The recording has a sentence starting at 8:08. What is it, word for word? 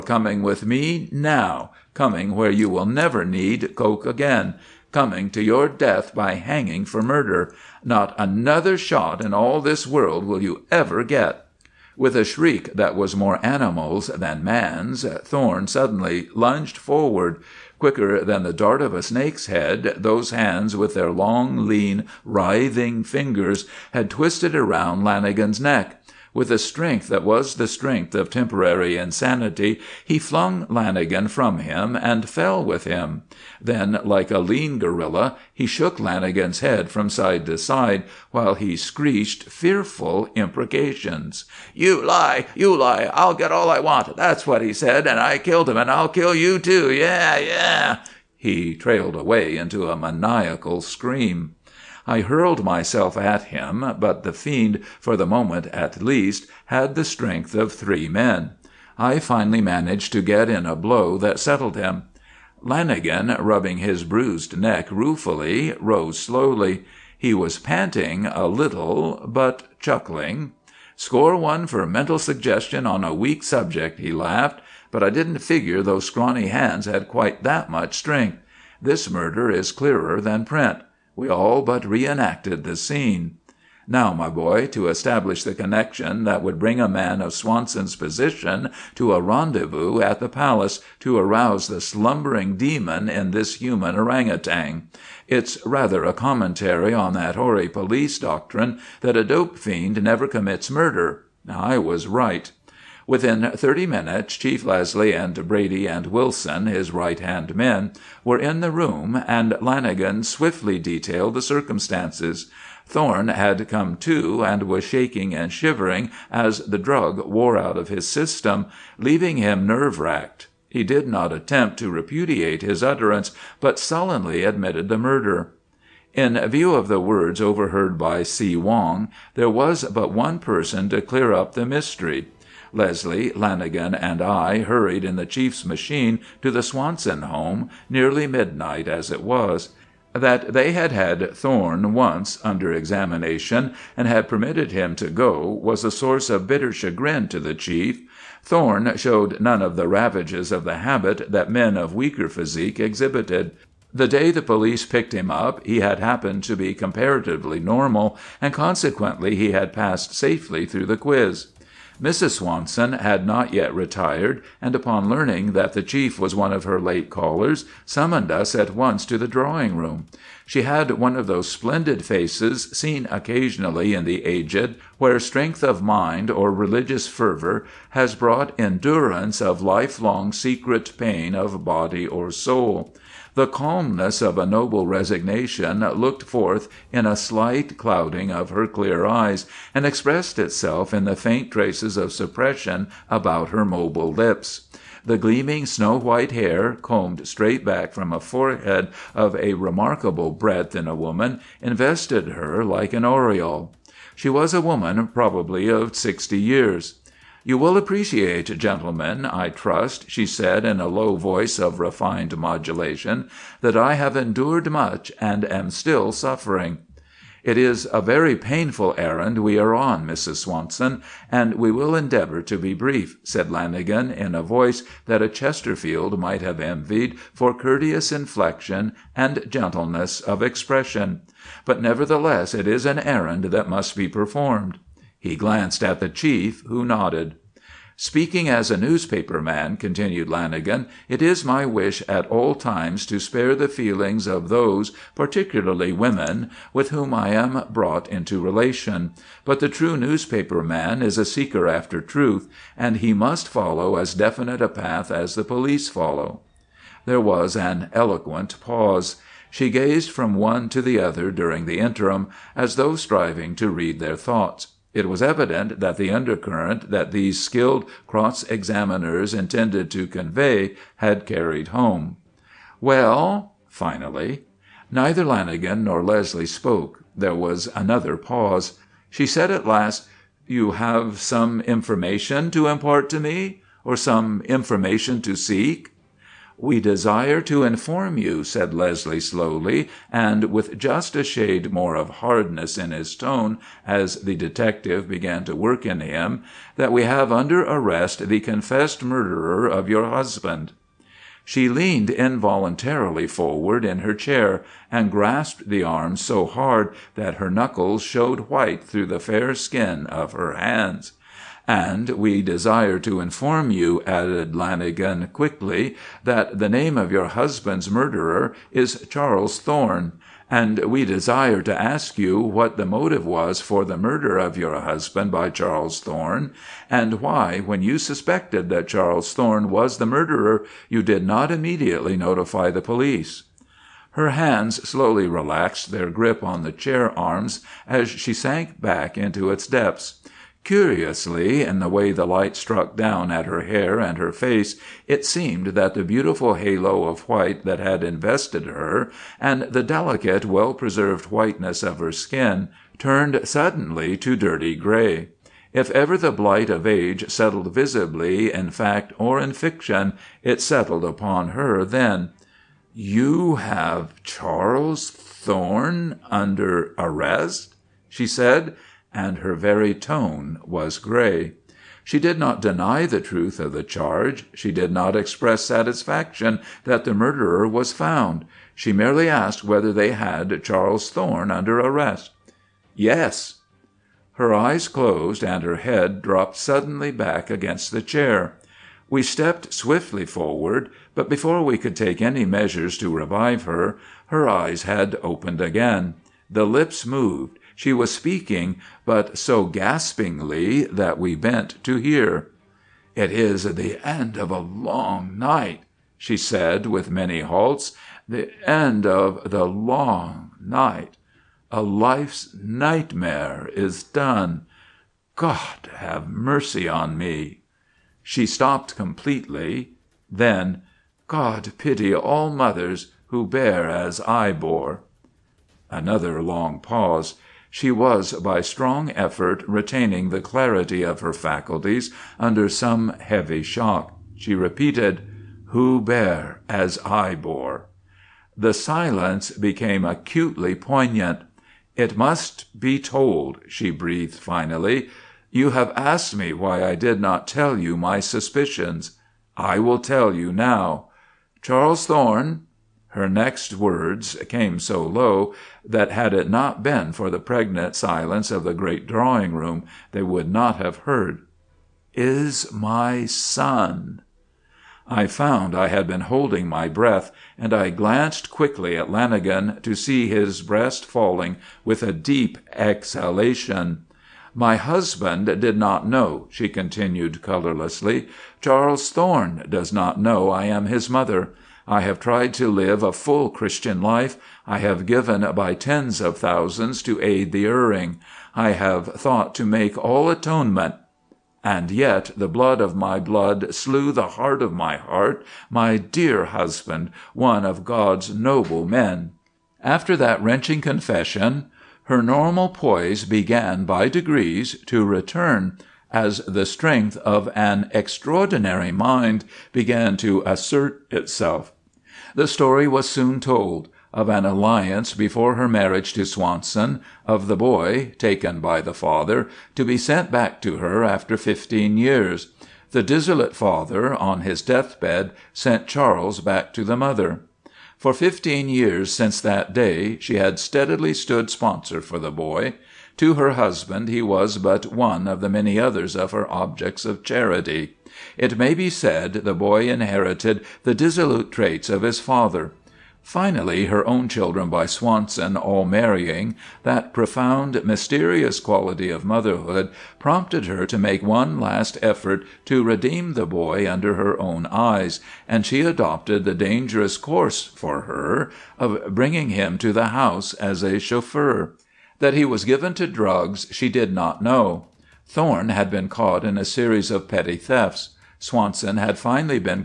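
I have thought to make all atonement.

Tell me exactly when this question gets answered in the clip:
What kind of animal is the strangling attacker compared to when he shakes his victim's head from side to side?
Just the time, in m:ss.
0:34.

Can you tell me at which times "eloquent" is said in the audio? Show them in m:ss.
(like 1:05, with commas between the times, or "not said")
4:17.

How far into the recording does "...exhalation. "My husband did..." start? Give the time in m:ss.
7:52.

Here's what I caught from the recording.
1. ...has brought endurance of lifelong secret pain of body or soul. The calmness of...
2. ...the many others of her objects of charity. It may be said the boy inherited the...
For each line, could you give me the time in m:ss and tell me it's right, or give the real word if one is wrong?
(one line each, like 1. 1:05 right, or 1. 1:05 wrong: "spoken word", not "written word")
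1. 2:57 right
2. 8:55 right.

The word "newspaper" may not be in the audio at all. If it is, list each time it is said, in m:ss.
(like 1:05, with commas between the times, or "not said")
3:58, 4:09.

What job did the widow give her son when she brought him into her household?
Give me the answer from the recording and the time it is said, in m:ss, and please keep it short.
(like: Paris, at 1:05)
chauffeur, at 9:20.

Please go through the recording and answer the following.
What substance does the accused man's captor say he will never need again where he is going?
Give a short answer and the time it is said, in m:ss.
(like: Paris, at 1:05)
coke, at 0:03.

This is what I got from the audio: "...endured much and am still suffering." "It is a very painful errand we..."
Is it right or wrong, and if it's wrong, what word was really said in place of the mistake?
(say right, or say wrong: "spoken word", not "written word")
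right.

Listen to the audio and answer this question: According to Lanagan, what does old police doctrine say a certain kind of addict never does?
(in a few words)
commits murder.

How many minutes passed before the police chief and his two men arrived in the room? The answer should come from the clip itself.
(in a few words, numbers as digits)
30.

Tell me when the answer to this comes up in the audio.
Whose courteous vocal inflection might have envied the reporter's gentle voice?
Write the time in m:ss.
3:45.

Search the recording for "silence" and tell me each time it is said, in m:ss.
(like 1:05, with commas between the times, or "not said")
7:18, 7:37.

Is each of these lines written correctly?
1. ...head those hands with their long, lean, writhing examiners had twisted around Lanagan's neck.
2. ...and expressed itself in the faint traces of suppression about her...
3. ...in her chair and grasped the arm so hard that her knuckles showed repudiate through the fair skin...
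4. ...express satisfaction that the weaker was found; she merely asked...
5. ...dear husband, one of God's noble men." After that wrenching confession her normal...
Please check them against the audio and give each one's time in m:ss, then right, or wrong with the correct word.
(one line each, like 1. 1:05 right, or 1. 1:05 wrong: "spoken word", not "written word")
1. 0:19 wrong: "fingers", not "examiners"
2. 3:09 right
3. 5:03 wrong: "white", not "repudiate"
4. 6:15 wrong: "murderer", not "weaker"
5. 8:15 right.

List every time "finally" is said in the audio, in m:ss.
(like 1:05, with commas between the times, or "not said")
0:59, 4:33, 7:24, 9:03, 9:29.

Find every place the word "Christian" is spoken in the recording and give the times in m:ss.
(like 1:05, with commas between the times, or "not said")
8:03.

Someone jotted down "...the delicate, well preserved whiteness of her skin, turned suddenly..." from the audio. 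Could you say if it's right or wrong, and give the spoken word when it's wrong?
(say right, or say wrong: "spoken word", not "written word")
right.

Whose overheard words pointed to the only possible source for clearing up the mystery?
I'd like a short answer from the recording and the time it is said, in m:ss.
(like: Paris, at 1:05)
See Wong, at 2:08.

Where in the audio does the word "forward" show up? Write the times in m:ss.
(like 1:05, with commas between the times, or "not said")
0:16, 5:03, 6:30.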